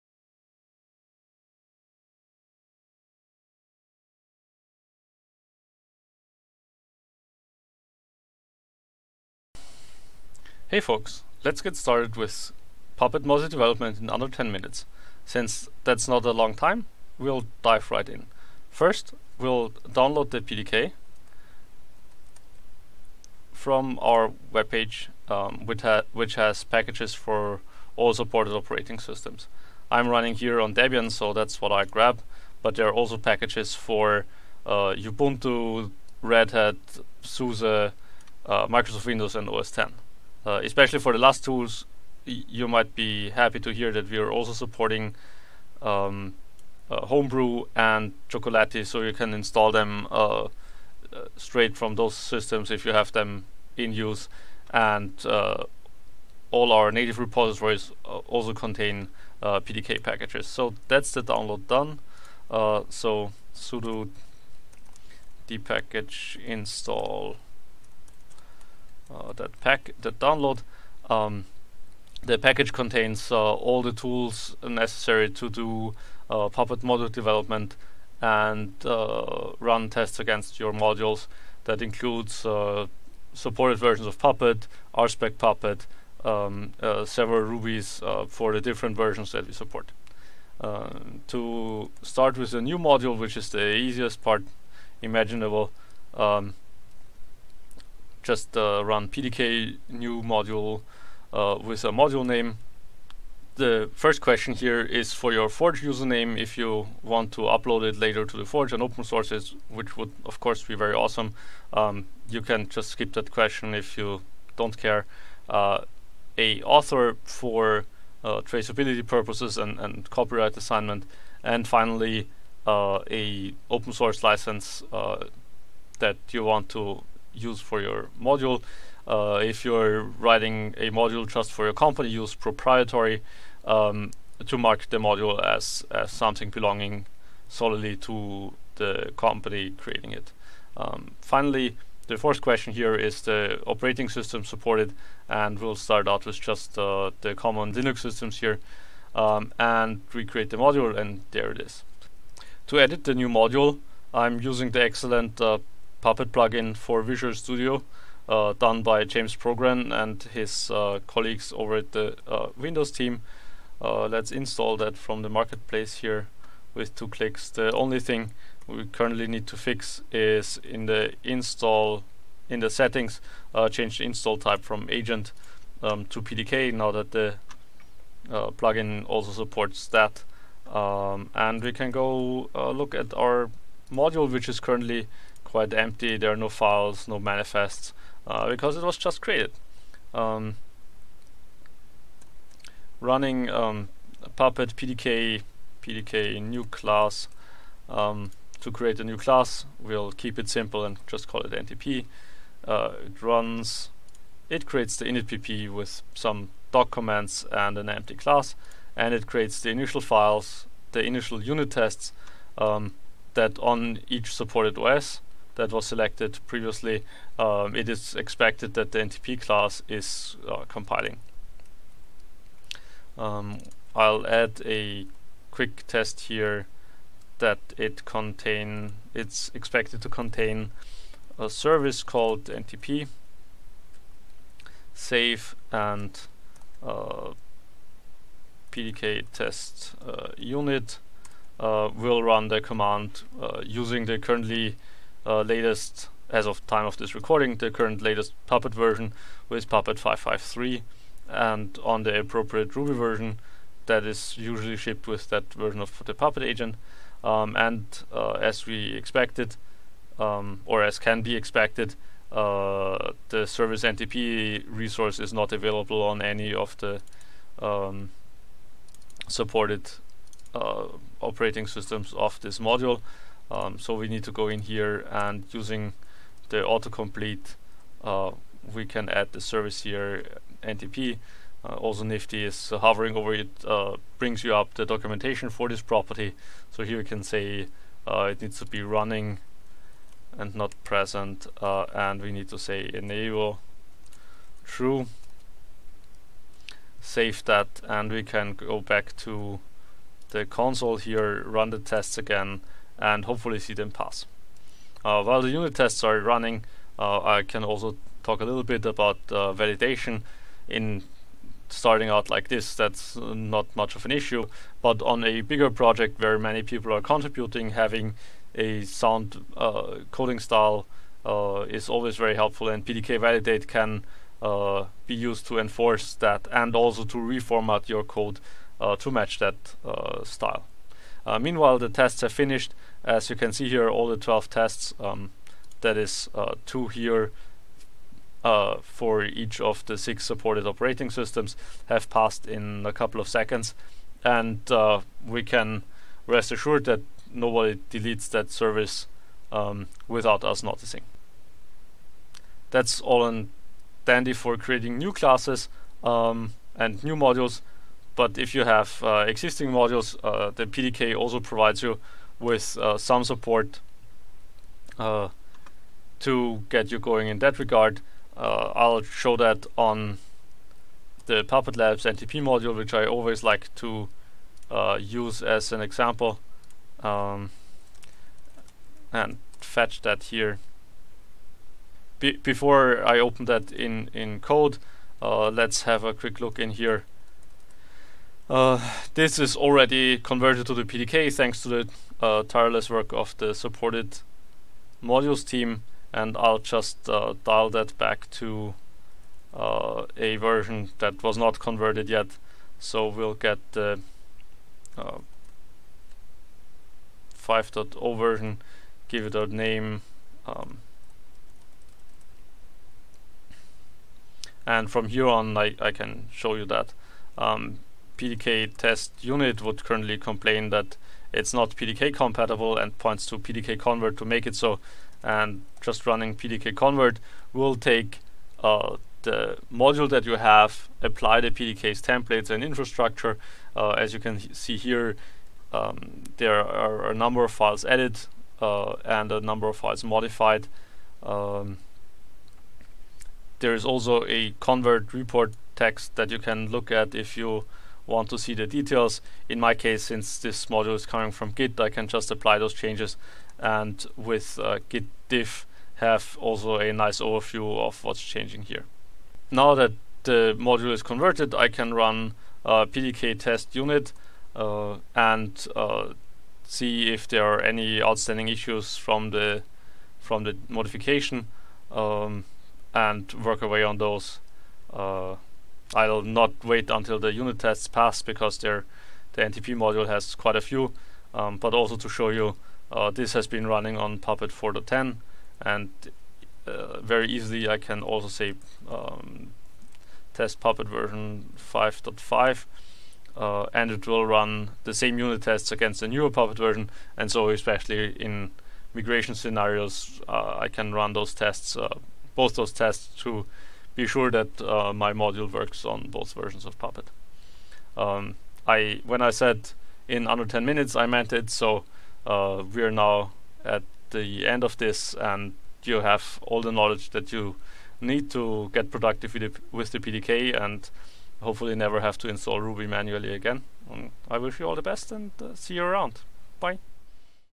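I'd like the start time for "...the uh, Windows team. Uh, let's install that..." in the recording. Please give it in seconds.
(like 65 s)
161 s.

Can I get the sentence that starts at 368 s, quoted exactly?
Uh, I'll show that on the Puppet Labs NTP module, which I always like to use as an example.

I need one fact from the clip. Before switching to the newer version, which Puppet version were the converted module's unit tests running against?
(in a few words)
Puppet 4.10.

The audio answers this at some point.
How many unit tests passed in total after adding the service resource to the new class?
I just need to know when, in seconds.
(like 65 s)
334 s.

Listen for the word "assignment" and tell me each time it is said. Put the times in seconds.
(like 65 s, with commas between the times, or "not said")
120 s.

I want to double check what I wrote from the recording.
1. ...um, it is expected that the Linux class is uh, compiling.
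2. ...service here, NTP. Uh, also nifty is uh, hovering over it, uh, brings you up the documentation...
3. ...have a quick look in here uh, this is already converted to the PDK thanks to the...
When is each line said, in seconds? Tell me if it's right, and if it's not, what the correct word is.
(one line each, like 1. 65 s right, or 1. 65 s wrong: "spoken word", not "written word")
1. 217 s wrong: "NTP", not "Linux"
2. 279 s right
3. 385 s right.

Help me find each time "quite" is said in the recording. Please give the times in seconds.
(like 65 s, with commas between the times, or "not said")
185 s, 480 s.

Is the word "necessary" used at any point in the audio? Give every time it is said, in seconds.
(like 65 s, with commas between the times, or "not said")
74 s.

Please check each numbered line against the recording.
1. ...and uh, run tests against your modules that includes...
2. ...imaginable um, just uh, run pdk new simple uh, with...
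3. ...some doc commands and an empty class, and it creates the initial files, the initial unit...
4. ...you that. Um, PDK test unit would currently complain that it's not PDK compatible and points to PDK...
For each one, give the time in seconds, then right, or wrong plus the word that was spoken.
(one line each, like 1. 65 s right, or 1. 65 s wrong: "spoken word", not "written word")
1. 78 s right
2. 95 s wrong: "module", not "simple"
3. 206 s right
4. 416 s right.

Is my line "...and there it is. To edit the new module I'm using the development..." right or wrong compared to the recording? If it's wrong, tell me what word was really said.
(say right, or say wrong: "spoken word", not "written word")
wrong: "excellent", not "development".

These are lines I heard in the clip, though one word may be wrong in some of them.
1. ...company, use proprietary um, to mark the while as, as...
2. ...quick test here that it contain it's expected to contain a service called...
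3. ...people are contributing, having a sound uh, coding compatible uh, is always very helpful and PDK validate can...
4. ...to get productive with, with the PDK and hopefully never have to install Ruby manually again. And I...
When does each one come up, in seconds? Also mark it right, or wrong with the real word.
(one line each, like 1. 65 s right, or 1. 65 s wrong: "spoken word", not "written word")
1. 131 s wrong: "module", not "while"
2. 225 s right
3. 316 s wrong: "style", not "compatible"
4. 518 s right.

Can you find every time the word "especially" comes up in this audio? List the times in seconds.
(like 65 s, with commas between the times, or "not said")
40 s, 497 s.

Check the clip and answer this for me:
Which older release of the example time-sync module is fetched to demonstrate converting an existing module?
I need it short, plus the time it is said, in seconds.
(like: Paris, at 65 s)
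5.0, at 404 s.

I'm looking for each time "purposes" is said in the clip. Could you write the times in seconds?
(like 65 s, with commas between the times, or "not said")
119 s.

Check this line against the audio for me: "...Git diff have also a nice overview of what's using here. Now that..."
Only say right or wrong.
wrong.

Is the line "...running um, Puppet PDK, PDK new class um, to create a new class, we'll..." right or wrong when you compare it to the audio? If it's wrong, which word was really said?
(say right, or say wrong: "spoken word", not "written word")
right.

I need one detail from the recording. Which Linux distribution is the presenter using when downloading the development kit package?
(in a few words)
Debian.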